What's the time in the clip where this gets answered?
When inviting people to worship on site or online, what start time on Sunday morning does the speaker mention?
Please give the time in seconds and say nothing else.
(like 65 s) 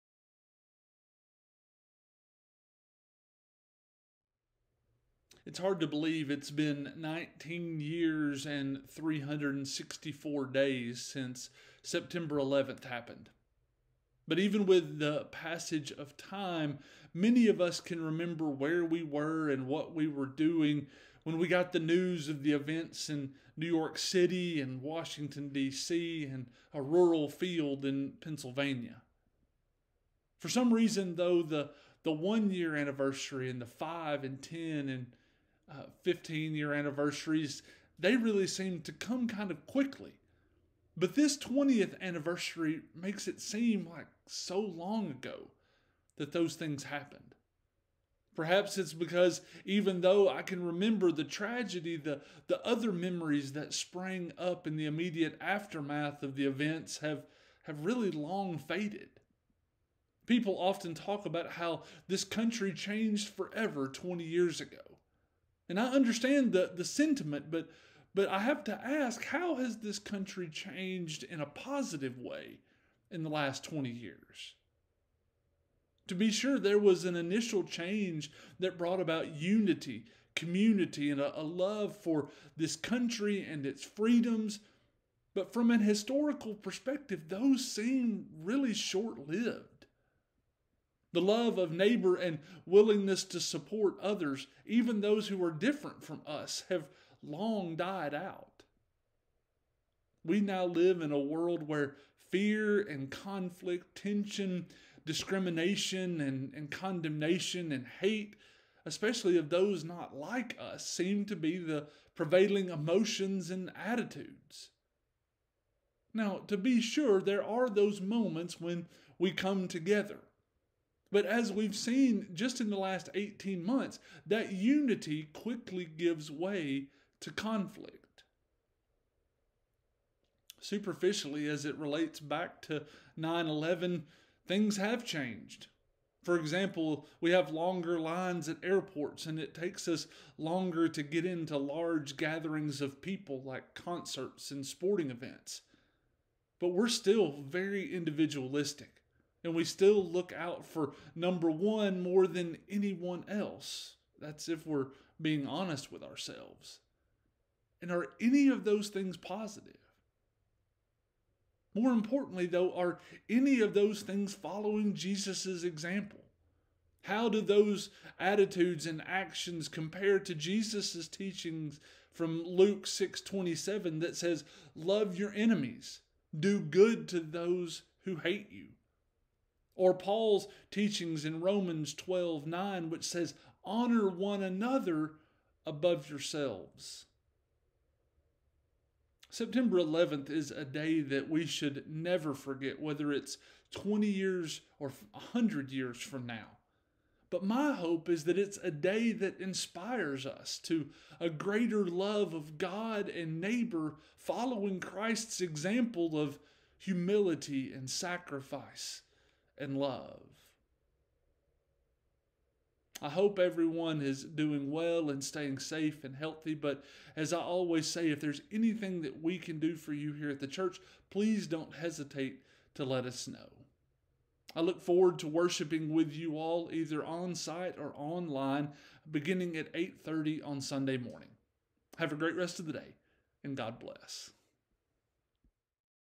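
229 s.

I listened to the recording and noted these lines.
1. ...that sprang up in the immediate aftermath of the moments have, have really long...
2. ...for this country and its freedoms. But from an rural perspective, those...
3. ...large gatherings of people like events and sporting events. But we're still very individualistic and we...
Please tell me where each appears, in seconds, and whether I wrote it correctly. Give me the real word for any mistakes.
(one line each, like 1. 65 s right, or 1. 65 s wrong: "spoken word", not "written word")
1. 53 s wrong: "events", not "moments"
2. 81 s wrong: "historical", not "rural"
3. 141 s wrong: "concerts", not "events".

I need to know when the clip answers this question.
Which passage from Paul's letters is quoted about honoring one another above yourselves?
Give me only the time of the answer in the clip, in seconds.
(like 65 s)
181 s.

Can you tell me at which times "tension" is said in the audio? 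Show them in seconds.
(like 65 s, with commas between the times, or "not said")
104 s.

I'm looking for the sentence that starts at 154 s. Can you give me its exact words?
That's if we're being honest with ourselves.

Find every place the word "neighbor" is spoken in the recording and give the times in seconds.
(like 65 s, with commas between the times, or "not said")
91 s, 203 s.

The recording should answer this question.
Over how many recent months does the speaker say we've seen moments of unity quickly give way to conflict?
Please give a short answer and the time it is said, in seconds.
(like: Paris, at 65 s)
18, at 123 s.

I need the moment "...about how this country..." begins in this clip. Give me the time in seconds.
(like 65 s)
61 s.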